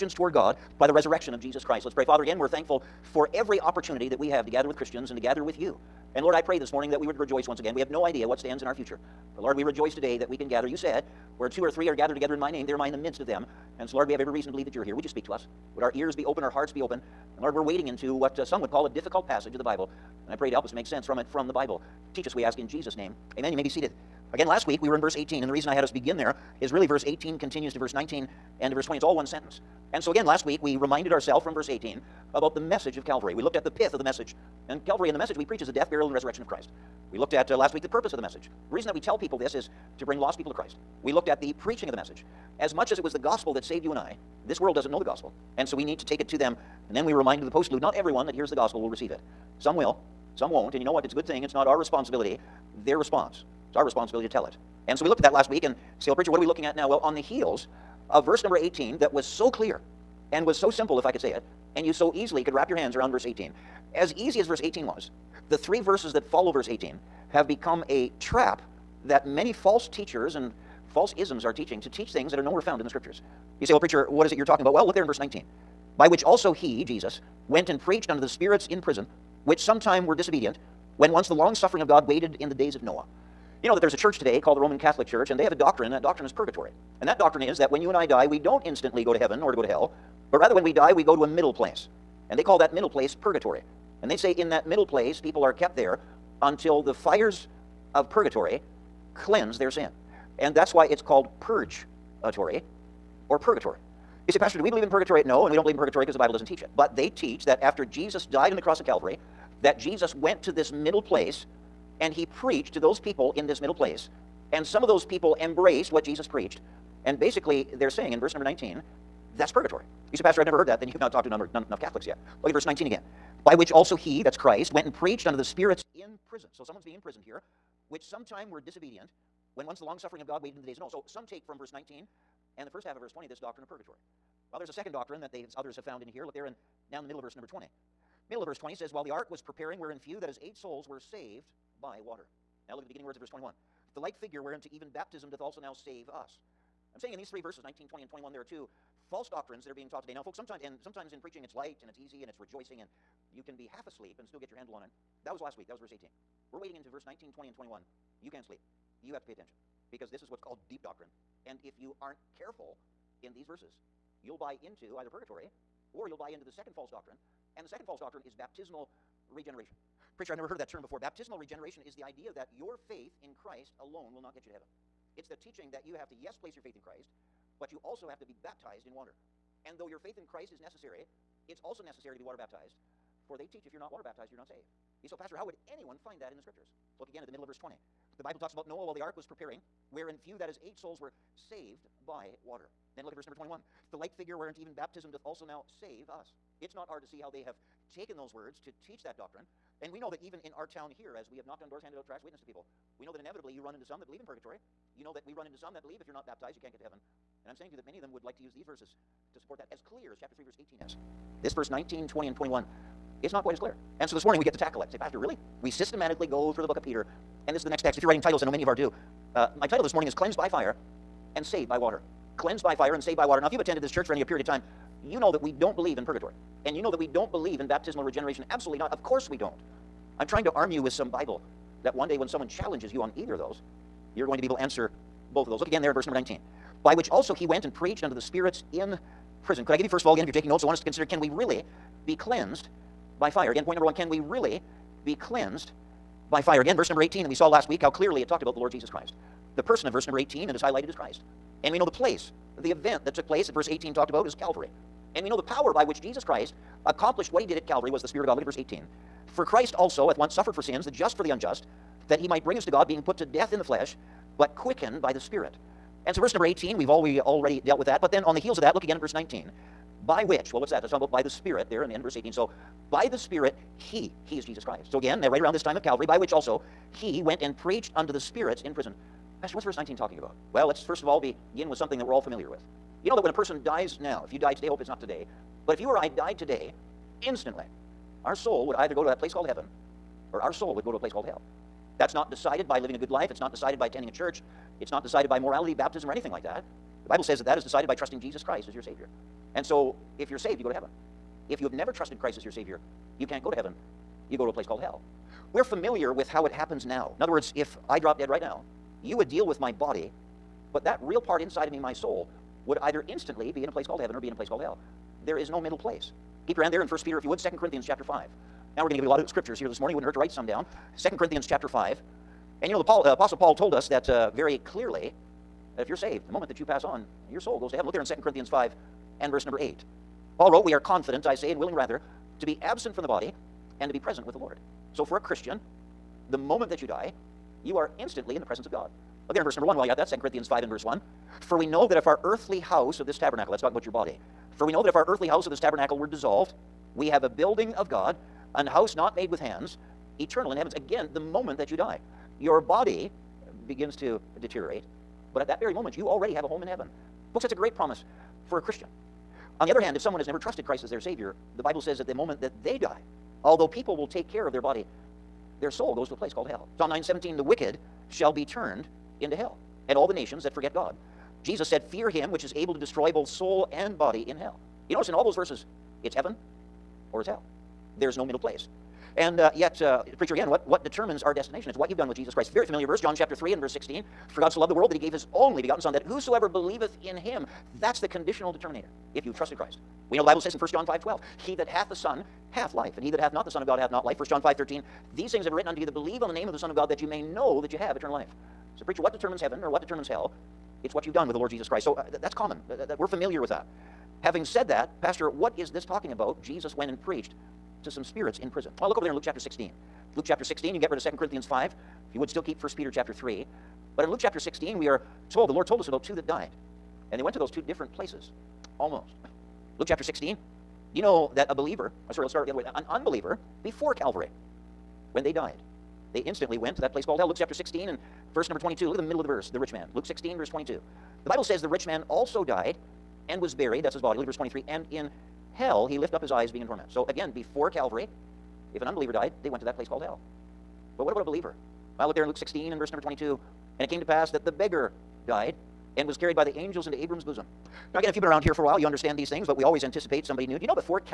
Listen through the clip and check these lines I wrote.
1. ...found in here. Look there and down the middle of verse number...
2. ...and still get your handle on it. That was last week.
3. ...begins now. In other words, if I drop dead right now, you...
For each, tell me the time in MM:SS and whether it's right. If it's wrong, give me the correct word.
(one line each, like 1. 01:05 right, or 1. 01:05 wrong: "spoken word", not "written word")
1. 02:15 right
2. 02:34 right
3. 05:06 wrong: "happens", not "begins".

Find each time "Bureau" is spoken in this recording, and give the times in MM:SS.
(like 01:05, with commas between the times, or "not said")
not said.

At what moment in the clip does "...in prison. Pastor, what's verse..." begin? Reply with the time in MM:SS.
04:38.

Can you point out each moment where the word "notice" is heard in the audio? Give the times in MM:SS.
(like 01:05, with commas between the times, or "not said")
06:14.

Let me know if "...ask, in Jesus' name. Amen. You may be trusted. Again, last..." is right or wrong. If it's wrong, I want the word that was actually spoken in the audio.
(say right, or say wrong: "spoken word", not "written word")
wrong: "seated", not "trusted".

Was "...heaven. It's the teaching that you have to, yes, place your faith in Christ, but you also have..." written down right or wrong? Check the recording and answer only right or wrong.
right.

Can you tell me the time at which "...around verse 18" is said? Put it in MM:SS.
01:02.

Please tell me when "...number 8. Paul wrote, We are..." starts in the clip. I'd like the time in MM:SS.
05:29.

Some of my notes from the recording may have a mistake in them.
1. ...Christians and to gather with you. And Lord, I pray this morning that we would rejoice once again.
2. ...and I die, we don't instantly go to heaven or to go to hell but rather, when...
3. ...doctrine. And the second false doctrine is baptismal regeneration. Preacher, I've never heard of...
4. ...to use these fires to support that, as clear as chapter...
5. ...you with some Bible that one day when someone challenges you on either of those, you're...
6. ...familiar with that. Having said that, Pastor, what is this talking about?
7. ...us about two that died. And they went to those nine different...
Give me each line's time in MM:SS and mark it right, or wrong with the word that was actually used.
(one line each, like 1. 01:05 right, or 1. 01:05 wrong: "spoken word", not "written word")
1. 00:04 right
2. 01:27 right
3. 02:46 right
4. 03:28 wrong: "verses", not "fires"
5. 03:50 right
6. 06:43 right
7. 06:55 wrong: "two", not "nine".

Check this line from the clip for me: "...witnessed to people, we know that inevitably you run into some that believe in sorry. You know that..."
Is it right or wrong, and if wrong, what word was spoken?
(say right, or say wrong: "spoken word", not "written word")
wrong: "purgatory", not "sorry".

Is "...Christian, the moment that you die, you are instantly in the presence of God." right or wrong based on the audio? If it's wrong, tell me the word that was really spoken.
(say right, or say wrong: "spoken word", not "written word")
right.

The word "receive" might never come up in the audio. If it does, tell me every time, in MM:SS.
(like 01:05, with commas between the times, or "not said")
00:48.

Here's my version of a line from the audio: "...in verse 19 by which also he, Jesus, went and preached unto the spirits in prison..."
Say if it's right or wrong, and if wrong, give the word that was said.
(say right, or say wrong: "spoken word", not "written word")
right.